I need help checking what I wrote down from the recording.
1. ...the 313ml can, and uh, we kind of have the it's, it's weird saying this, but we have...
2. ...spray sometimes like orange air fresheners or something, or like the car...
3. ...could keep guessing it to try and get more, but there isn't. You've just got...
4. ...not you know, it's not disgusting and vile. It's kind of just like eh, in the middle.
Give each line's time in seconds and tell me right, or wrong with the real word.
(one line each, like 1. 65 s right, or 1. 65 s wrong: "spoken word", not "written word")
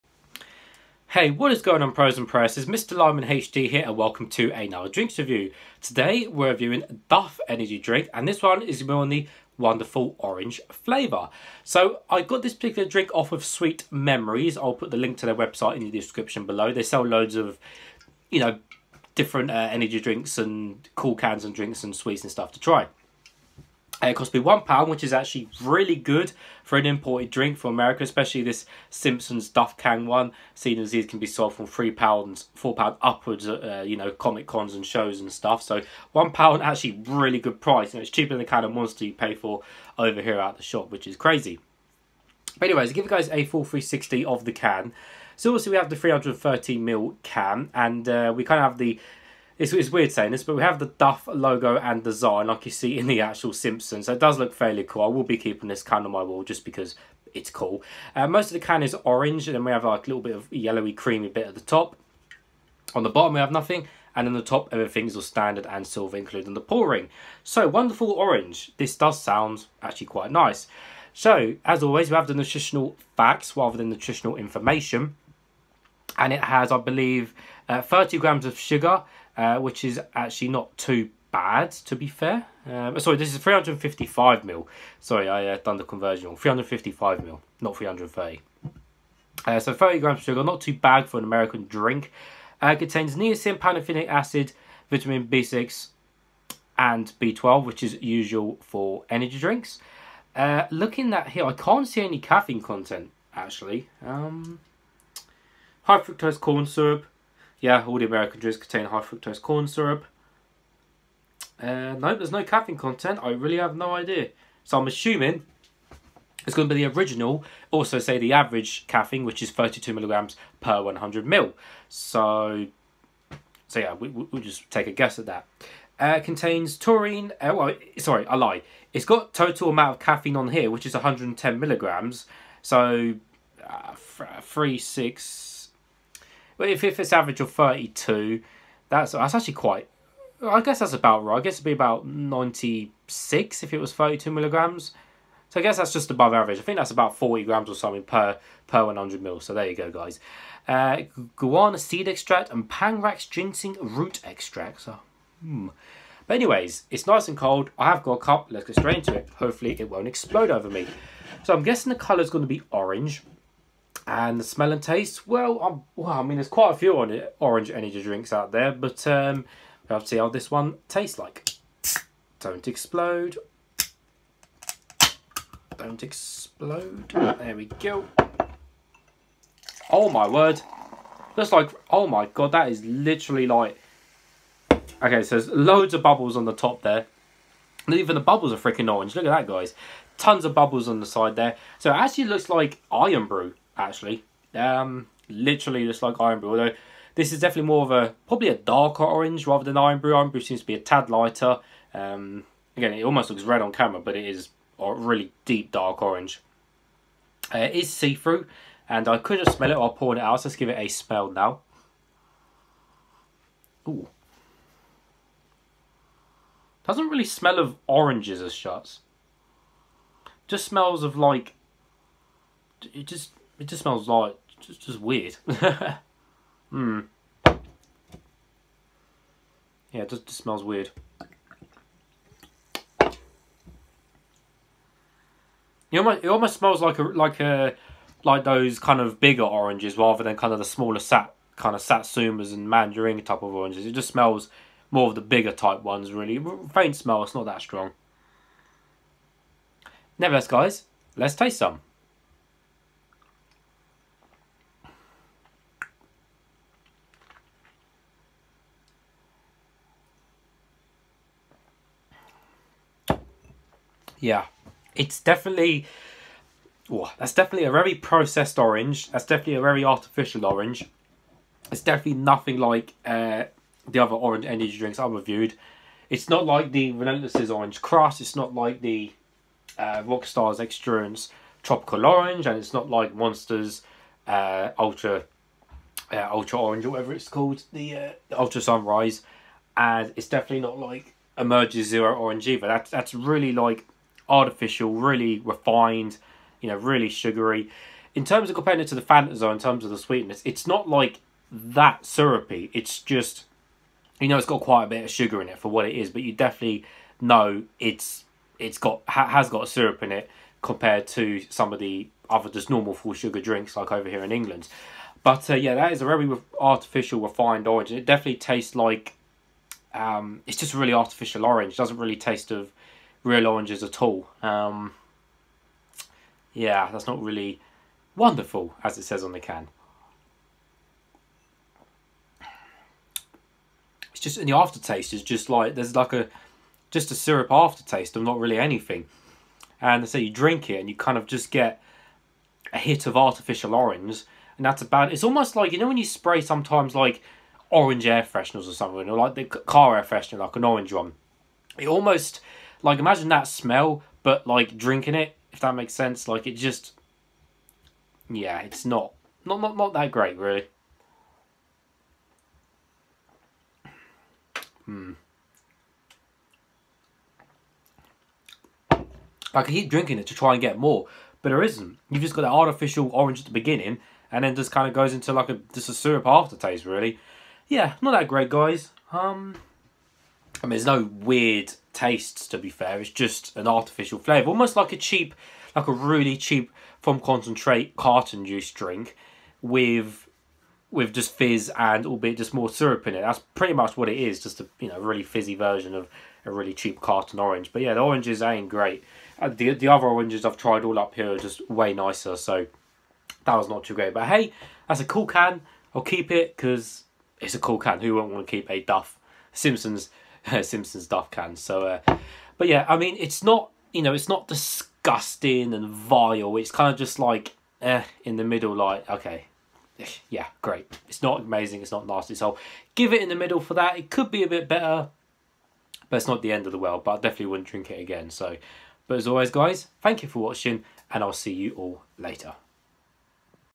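1. 45 s right
2. 346 s right
3. 369 s wrong: "drinking", not "guessing"
4. 413 s right.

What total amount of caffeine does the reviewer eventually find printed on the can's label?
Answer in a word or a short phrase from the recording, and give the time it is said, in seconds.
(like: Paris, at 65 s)
110 milligrams, at 130 s.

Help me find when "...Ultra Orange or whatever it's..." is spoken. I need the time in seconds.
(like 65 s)
286 s.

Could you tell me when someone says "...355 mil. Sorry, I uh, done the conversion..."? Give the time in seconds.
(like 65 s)
83 s.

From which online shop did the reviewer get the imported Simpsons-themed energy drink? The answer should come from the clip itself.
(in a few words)
Sweet Memories.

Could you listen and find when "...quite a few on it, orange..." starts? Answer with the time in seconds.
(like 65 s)
166 s.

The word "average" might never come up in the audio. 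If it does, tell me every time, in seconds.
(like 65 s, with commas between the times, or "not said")
118 s, 137 s, 146 s.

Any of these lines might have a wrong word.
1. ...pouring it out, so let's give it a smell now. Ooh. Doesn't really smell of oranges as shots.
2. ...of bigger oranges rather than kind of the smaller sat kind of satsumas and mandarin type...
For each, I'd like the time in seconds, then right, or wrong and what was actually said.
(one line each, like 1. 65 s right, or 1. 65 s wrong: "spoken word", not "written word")
1. 209 s right
2. 239 s right.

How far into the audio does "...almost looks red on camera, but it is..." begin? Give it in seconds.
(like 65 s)
203 s.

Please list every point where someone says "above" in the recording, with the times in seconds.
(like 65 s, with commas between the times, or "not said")
146 s.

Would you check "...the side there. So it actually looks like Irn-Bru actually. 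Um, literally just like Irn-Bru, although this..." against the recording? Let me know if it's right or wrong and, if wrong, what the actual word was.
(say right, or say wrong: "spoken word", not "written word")
right.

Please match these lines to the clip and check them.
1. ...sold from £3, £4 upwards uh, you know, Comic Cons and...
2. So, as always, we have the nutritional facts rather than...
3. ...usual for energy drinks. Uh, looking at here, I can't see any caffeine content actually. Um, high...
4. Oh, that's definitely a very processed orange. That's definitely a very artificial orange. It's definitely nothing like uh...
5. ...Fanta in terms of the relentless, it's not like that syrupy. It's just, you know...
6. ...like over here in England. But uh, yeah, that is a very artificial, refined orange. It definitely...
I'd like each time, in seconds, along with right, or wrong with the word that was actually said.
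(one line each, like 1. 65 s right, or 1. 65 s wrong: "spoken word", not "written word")
1. 31 s right
2. 71 s right
3. 98 s right
4. 266 s right
5. 299 s wrong: "sweetness", not "relentless"
6. 313 s right.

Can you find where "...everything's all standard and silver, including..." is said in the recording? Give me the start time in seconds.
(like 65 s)
64 s.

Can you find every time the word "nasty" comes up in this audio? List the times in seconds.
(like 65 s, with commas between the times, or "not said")
422 s.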